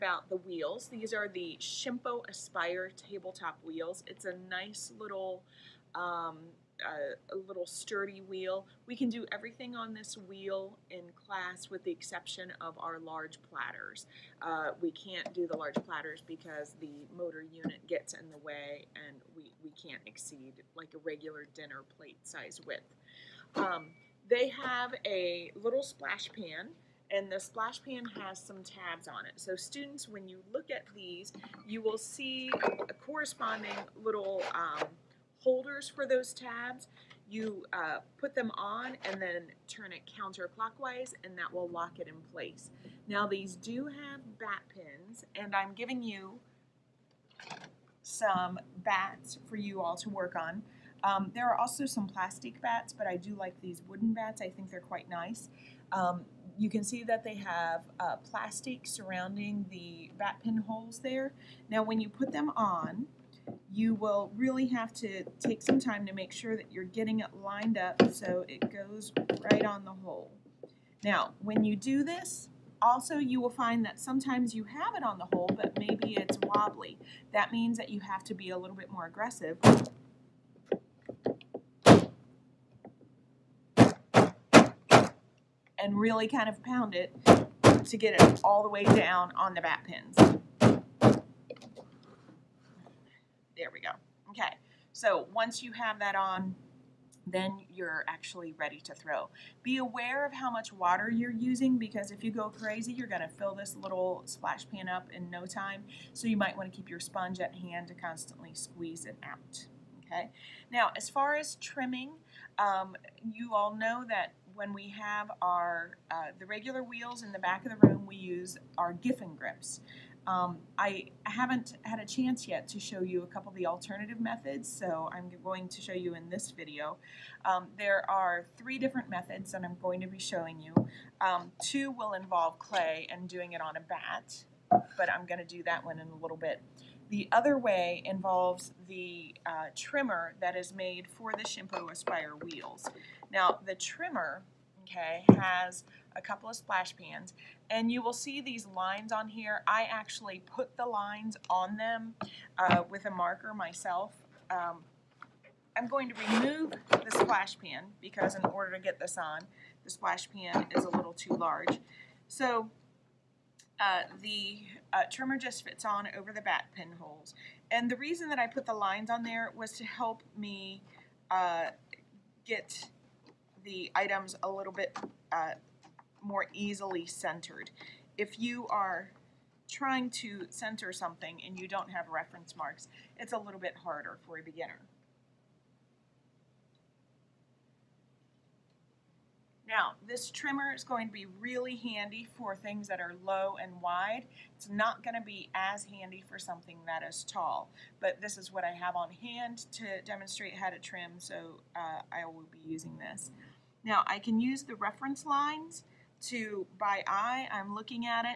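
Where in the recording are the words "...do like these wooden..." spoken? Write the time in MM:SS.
00:53.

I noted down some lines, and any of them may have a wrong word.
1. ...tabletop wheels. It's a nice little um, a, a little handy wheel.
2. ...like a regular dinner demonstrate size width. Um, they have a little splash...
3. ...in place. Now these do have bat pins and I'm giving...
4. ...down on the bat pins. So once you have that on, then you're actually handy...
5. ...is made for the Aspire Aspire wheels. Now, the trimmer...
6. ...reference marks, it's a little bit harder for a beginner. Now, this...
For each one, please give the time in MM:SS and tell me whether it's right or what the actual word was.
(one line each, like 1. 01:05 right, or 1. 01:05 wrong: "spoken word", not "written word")
1. 00:02 wrong: "sturdy", not "handy"
2. 00:20 wrong: "plate", not "demonstrate"
3. 00:42 right
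4. 01:28 wrong: "ready", not "handy"
5. 02:20 wrong: "Shimpo", not "Aspire"
6. 03:02 right.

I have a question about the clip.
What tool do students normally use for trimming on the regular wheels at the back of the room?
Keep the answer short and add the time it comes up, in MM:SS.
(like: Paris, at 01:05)
Giffin grips, at 01:58.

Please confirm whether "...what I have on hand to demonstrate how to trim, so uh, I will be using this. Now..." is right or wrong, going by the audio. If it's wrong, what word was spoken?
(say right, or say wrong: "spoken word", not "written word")
right.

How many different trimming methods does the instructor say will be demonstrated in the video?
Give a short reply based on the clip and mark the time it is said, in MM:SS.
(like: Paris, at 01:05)
3, at 02:08.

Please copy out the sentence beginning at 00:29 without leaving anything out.
So students, when you look at these, you will see a corresponding little um, holders for those tabs.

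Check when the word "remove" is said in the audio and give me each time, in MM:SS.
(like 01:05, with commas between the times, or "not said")
02:36.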